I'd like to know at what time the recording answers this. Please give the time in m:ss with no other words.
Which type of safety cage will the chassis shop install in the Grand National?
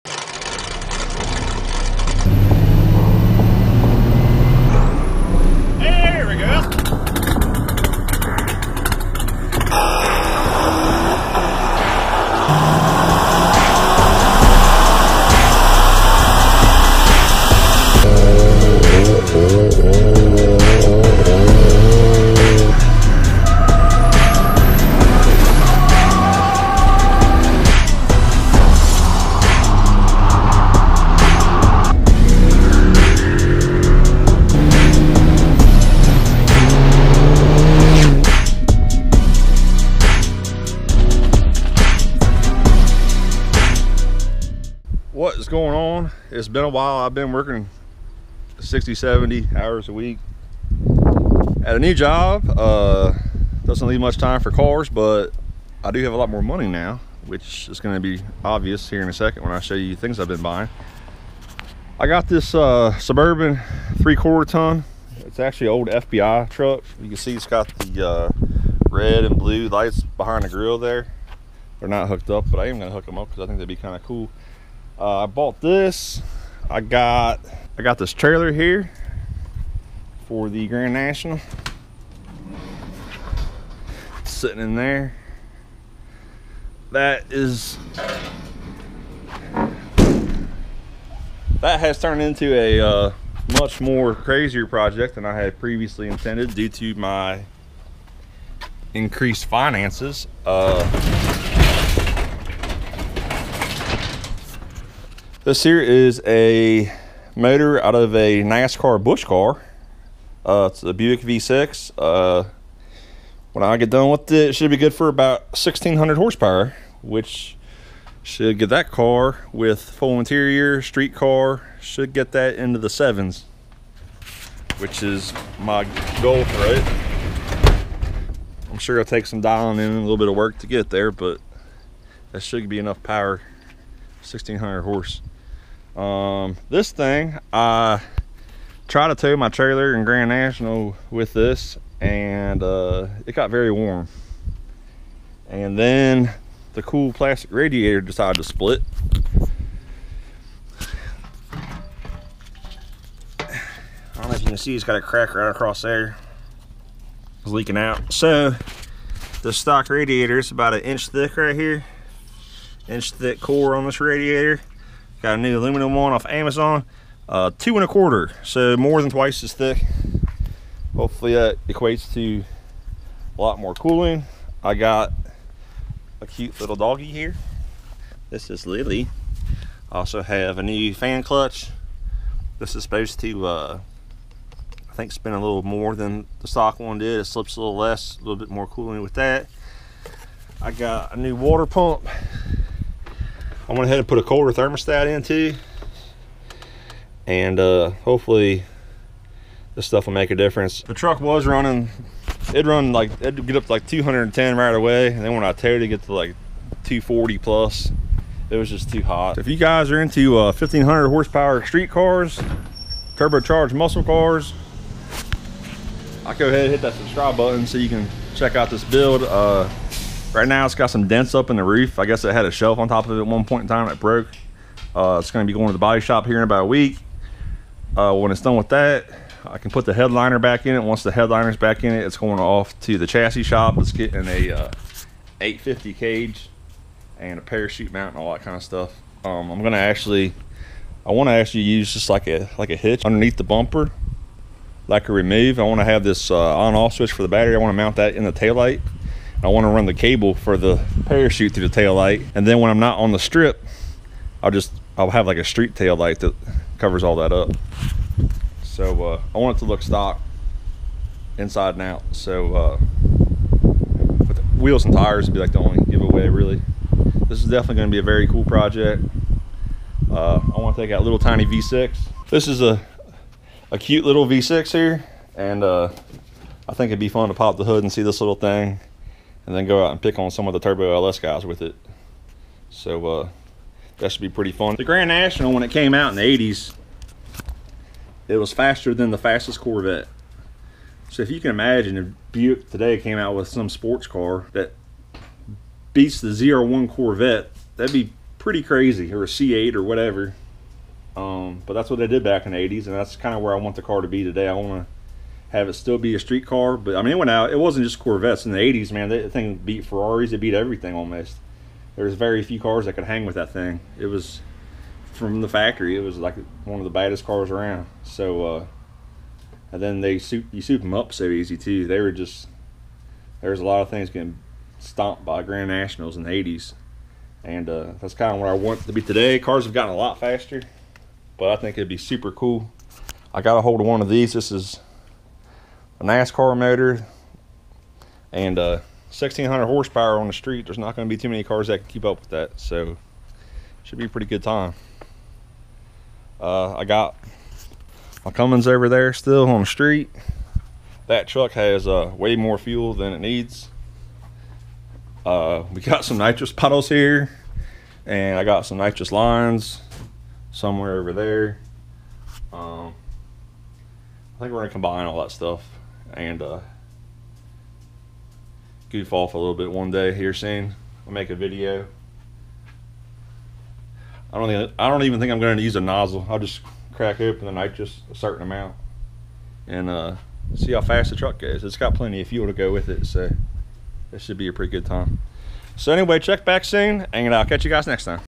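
3:55.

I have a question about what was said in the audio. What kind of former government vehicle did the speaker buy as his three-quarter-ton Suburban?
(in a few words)
FBI truck.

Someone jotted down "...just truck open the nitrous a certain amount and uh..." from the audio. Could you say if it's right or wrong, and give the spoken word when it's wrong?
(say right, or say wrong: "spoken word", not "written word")
wrong: "crack", not "truck".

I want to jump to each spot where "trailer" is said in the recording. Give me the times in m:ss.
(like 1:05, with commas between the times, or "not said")
1:18, 2:19.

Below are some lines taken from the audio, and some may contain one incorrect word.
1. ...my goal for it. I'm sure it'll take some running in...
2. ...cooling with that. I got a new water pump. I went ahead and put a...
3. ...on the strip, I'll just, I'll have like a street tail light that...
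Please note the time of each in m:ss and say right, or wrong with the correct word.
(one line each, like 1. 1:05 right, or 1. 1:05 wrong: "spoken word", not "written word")
1. 2:05 wrong: "dialing", not "running"
2. 3:08 right
3. 4:12 right.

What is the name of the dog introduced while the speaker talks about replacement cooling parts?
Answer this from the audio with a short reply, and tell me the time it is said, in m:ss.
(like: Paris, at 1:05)
Lily, at 2:58.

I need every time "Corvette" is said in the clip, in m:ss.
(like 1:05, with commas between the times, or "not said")
4:49, 4:56, 5:07.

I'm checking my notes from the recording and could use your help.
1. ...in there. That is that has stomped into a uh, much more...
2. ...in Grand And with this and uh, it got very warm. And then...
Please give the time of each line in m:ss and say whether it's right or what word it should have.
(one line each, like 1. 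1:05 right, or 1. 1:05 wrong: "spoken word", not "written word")
1. 1:24 wrong: "turned", not "stomped"
2. 2:19 wrong: "National", not "And".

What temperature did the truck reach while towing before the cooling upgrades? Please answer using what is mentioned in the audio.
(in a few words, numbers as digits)
240.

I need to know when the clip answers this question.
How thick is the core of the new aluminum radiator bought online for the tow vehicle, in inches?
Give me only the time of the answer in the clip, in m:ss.
2:47.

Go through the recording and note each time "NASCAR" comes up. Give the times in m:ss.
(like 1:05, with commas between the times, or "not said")
1:48, 5:36.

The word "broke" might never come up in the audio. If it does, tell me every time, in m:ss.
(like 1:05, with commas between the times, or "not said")
3:43.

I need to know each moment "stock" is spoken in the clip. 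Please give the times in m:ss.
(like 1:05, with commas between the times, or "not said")
2:39, 3:06, 4:19.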